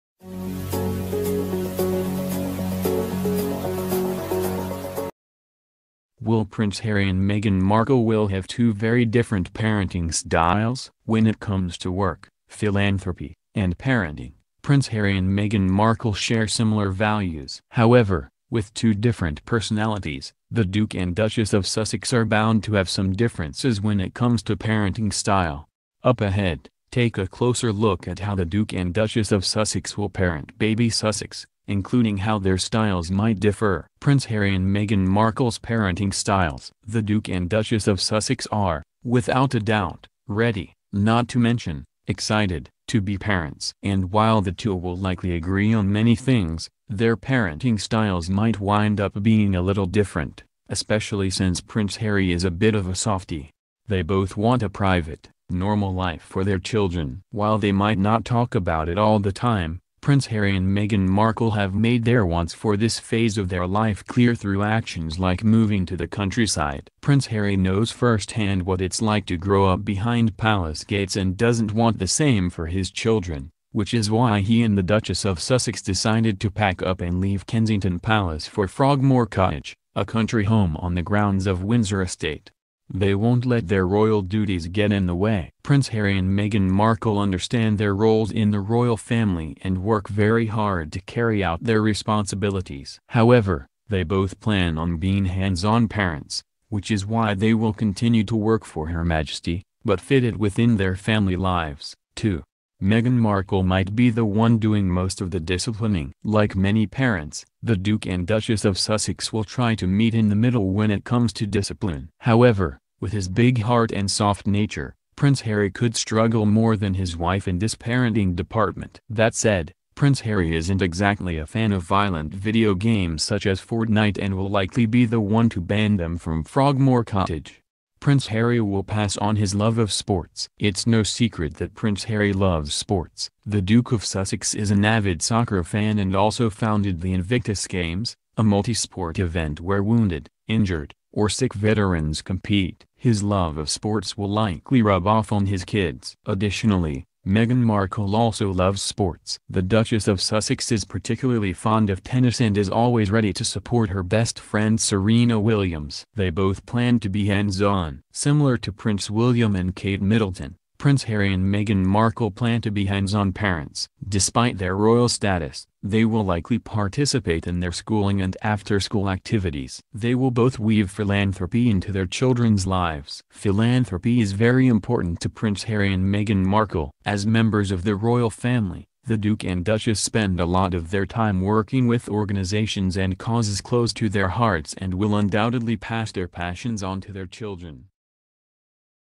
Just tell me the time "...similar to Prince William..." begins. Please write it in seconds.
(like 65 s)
158 s.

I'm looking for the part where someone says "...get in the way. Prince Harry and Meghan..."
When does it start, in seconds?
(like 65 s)
84 s.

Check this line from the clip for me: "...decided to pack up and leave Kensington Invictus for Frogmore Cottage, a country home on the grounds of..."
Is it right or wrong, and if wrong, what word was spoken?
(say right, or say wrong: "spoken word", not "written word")
wrong: "Palace", not "Invictus".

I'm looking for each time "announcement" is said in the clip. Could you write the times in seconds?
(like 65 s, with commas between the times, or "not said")
not said.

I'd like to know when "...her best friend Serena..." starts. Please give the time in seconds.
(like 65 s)
153 s.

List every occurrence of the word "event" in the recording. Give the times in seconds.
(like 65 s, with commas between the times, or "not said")
139 s.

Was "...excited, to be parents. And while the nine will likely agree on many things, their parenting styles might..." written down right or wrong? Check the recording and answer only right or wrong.
wrong.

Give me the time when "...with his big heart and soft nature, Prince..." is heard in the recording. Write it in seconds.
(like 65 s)
113 s.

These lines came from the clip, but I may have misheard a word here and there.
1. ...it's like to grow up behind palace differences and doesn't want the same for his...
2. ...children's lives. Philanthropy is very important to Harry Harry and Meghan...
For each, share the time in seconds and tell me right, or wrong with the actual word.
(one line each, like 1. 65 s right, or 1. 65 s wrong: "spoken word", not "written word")
1. 68 s wrong: "gates", not "differences"
2. 172 s wrong: "Prince", not "Harry".